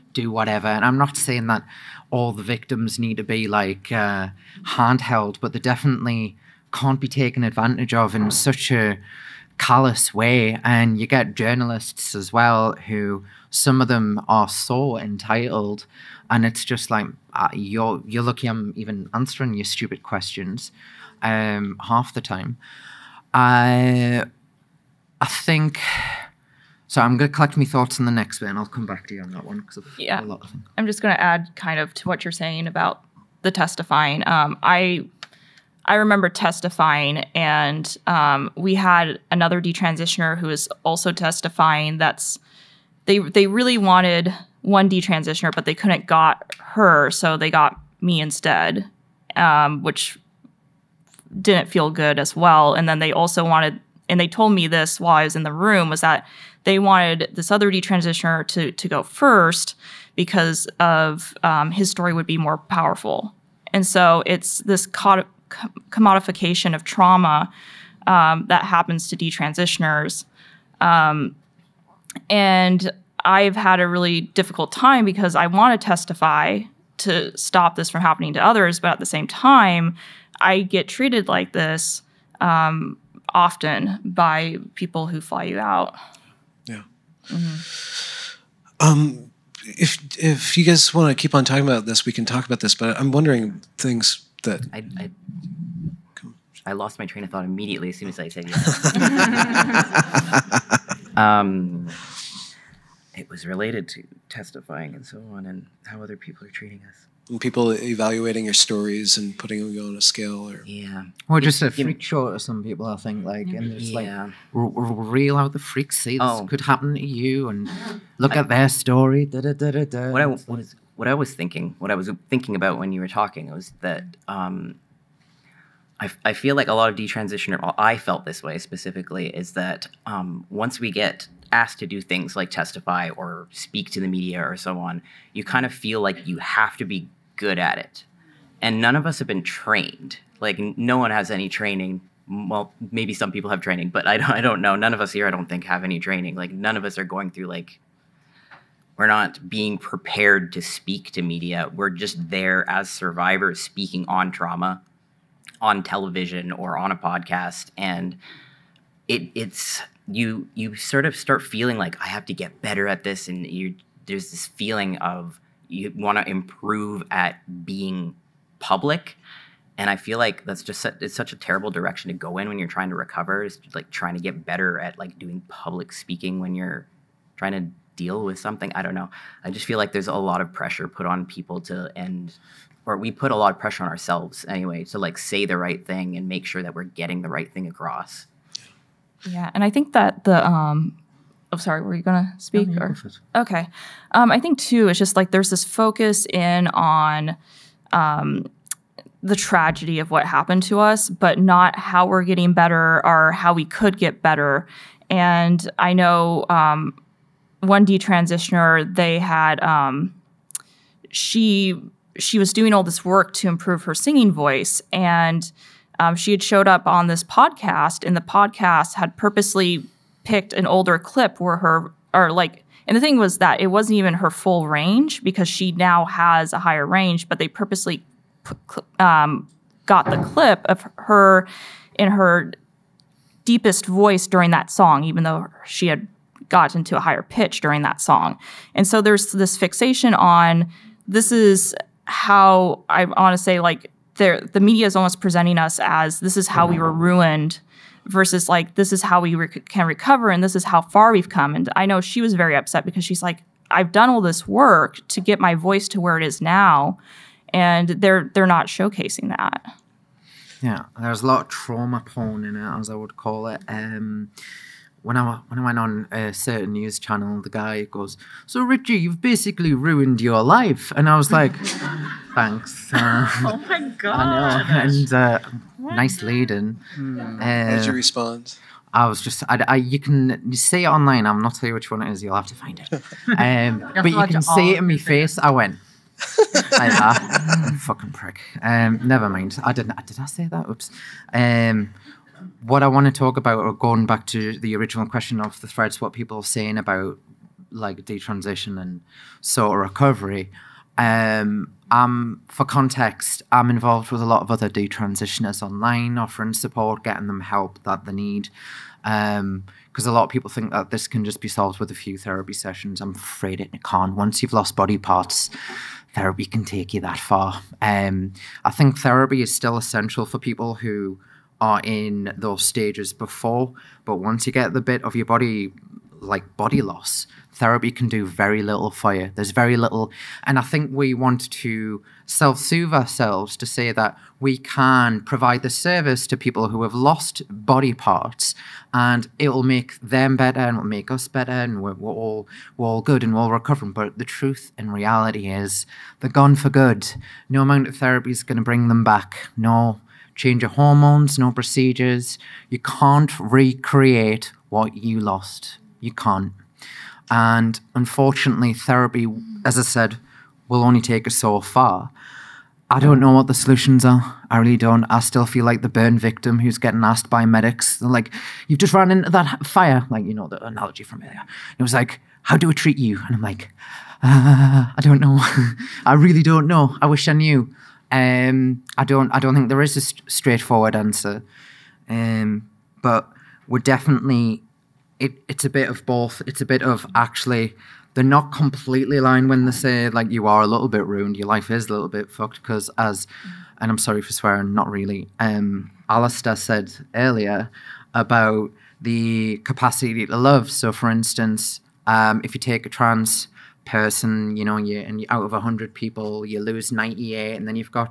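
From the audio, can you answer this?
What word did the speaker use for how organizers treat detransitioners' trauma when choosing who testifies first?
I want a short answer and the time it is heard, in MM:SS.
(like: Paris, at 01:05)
commodification, at 01:05.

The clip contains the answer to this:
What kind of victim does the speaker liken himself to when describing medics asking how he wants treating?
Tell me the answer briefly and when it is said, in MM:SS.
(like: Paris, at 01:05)
burn victim, at 06:05.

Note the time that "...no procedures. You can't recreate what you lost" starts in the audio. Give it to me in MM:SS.
05:51.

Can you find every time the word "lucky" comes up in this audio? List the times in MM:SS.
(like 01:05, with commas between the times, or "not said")
00:18.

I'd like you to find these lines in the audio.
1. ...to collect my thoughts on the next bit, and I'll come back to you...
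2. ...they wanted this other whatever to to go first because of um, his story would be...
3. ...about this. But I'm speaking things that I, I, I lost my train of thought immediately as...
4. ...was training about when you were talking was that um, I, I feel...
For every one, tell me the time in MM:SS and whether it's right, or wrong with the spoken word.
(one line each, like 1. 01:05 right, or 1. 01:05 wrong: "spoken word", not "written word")
1. 00:27 right
2. 00:56 wrong: "detransitioner", not "whatever"
3. 01:32 wrong: "wondering", not "speaking"
4. 02:01 wrong: "thinking", not "training".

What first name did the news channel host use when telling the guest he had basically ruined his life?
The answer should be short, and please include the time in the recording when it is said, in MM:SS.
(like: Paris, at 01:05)
Richie, at 04:28.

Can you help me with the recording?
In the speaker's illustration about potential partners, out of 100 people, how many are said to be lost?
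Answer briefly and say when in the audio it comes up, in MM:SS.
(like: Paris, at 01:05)
98, at 06:46.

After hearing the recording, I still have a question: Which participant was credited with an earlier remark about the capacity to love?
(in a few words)
Alistair.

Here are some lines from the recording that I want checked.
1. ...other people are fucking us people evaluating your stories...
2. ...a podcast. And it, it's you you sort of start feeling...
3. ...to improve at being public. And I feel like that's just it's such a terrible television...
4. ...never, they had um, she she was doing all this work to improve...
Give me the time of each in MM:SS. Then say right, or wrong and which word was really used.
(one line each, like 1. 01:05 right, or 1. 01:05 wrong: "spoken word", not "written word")
1. 01:46 wrong: "treating", not "fucking"
2. 02:36 right
3. 02:46 wrong: "direction", not "television"
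4. 03:27 wrong: "detransitioner", not "never".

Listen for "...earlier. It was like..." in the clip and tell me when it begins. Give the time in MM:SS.
06:11.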